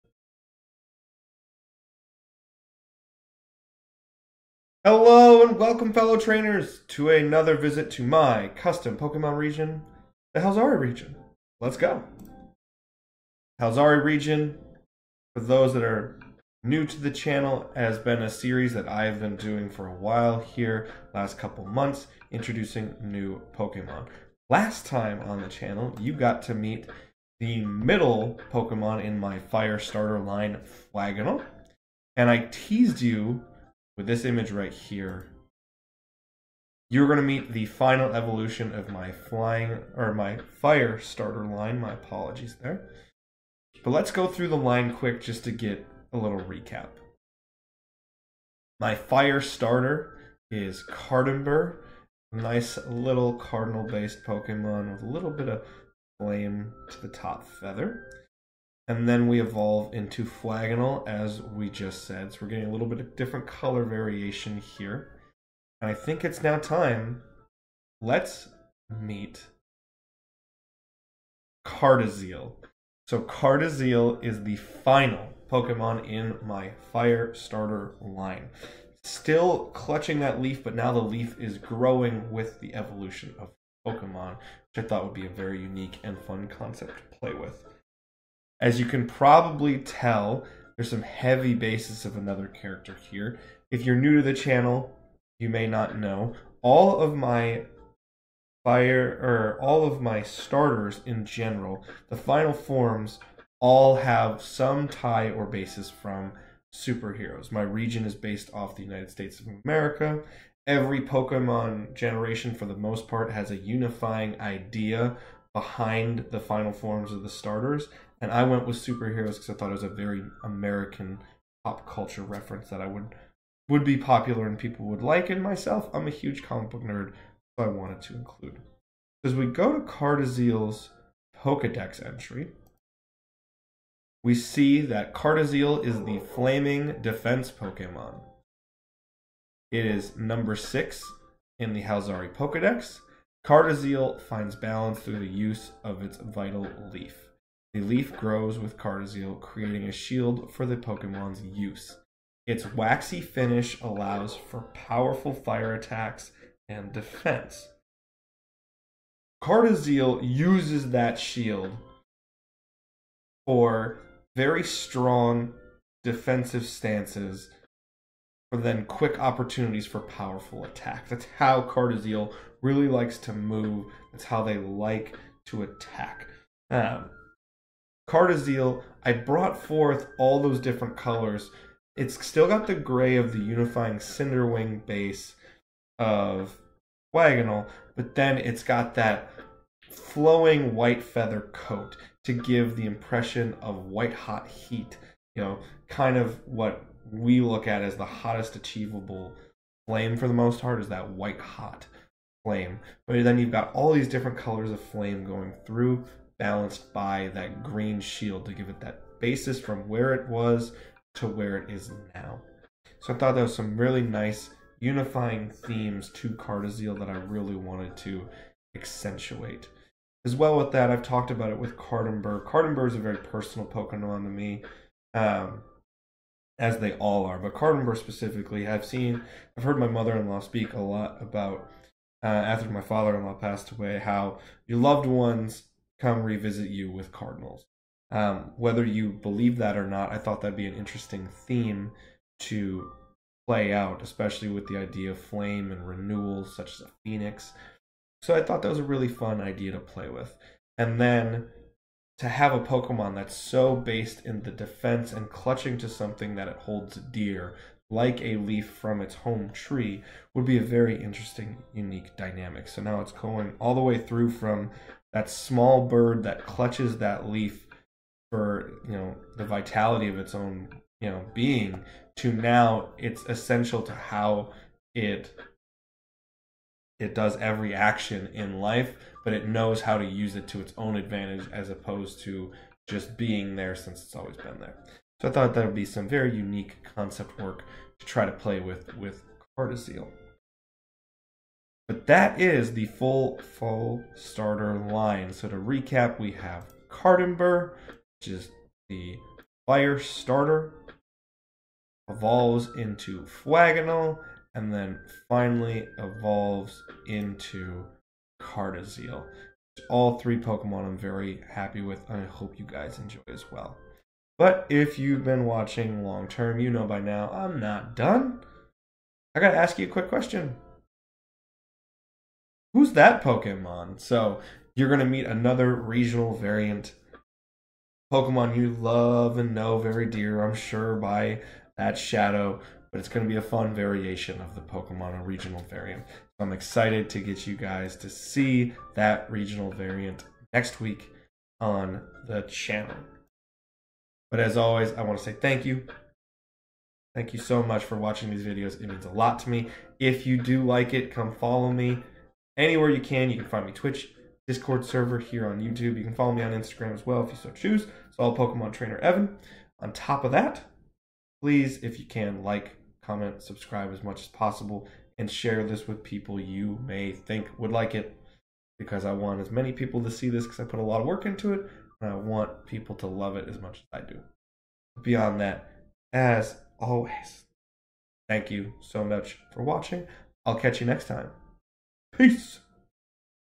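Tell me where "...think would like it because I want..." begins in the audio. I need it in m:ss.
6:07.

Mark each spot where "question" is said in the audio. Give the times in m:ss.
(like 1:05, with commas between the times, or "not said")
5:20.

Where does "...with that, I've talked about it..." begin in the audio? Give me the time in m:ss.
3:40.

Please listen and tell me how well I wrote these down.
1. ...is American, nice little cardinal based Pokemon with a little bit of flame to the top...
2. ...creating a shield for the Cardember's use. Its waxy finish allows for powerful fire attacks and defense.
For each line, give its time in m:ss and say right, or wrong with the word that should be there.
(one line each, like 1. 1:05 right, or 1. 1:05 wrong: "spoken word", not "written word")
1. 0:50 wrong: "Cardember", not "American"
2. 2:29 wrong: "Pokemon", not "Cardember".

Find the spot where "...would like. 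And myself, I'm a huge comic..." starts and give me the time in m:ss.
2:04.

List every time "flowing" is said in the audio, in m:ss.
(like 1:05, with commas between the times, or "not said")
3:09.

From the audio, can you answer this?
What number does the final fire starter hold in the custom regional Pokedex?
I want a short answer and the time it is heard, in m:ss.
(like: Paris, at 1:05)
6, at 2:20.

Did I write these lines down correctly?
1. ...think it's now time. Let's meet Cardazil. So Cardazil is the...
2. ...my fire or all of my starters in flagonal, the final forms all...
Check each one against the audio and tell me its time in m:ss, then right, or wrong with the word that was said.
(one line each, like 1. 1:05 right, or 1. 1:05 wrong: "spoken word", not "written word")
1. 1:05 right
2. 1:37 wrong: "general", not "flagonal".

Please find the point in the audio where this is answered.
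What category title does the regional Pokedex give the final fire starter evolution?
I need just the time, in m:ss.
2:16.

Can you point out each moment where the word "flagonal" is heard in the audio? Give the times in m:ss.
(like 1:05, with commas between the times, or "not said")
0:30, 1:00, 3:07, 5:03.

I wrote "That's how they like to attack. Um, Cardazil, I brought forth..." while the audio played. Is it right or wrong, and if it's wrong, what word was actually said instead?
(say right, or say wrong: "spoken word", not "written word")
right.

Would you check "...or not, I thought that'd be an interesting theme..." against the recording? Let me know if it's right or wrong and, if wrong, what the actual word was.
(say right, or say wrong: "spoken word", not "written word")
right.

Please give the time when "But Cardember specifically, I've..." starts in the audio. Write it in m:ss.
3:47.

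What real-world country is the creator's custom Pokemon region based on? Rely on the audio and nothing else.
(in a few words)
United States of America.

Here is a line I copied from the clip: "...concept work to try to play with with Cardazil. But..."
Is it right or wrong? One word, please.
right.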